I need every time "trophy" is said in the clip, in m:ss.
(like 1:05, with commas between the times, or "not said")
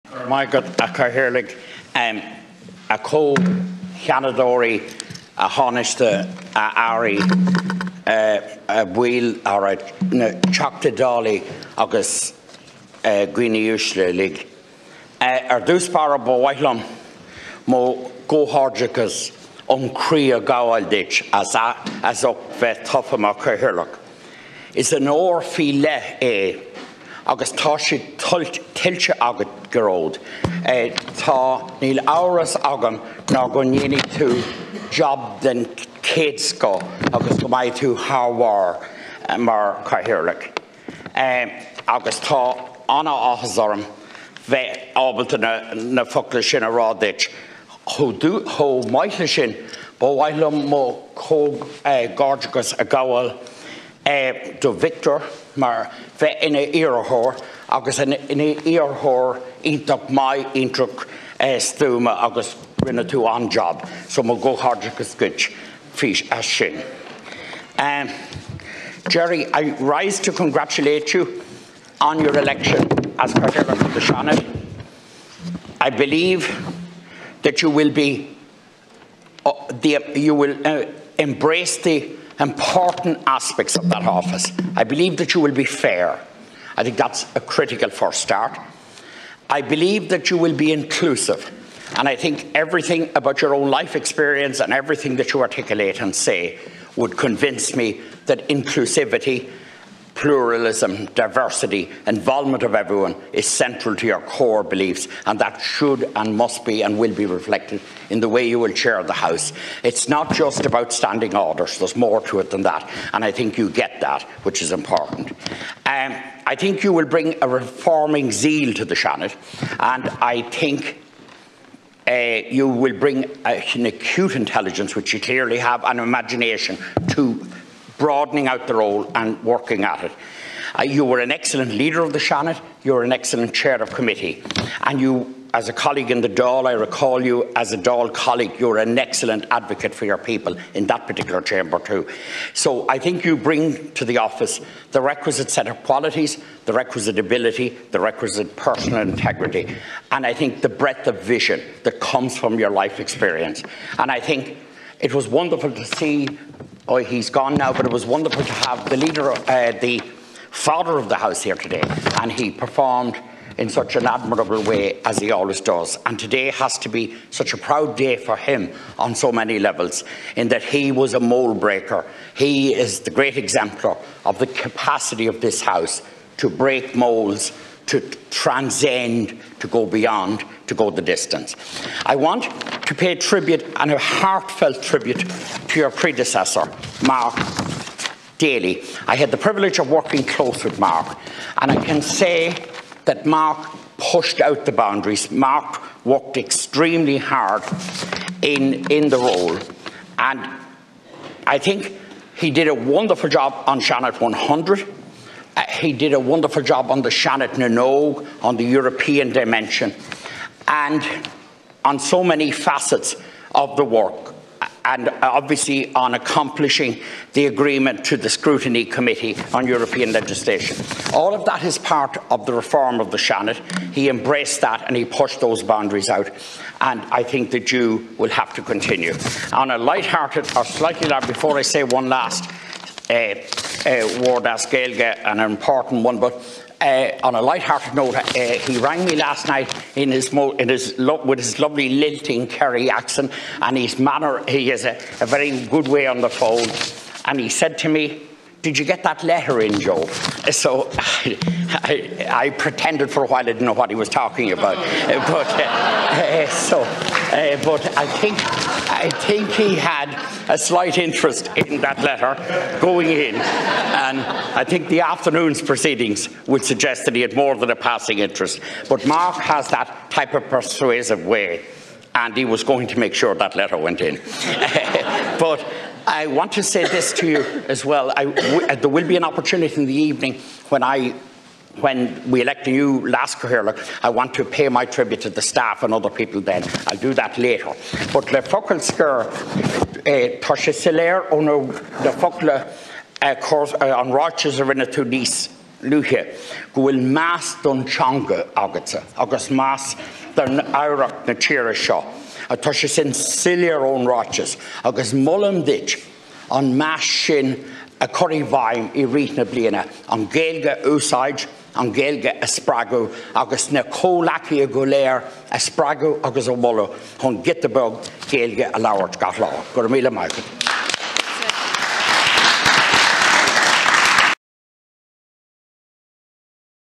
not said.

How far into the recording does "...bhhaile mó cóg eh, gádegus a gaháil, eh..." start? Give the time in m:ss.
0:50.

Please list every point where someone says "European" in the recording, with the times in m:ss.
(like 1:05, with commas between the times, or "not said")
3:28, 3:39.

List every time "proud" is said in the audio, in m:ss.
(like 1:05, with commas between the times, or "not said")
2:47.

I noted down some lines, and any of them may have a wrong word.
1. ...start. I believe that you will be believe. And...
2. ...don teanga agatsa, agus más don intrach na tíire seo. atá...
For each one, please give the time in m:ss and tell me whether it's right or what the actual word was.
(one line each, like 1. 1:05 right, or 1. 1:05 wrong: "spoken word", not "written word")
1. 1:28 wrong: "inclusive", not "believe"
2. 4:57 wrong: "áireach", not "intrach".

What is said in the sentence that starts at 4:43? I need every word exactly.
Look, I want to pay my tribute to the staff and other people then.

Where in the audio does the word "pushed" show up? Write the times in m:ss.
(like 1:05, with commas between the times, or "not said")
3:13, 3:45.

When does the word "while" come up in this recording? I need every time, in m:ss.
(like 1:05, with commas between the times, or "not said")
4:13.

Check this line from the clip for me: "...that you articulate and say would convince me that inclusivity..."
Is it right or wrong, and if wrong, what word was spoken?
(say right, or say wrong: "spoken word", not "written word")
right.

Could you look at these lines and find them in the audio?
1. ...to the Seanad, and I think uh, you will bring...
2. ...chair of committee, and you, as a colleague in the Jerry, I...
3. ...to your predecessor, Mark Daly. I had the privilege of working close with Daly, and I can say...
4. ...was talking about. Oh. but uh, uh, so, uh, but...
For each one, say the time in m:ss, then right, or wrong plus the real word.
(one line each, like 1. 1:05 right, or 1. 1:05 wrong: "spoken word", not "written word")
1. 1:58 right
2. 2:13 wrong: "Dáil", not "Jerry"
3. 3:05 wrong: "Mark", not "Daly"
4. 4:13 right.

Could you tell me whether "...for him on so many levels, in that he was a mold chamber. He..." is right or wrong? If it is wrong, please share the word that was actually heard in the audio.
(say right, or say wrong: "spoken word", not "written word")
wrong: "breaker", not "chamber".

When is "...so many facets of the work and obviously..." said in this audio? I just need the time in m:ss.
3:31.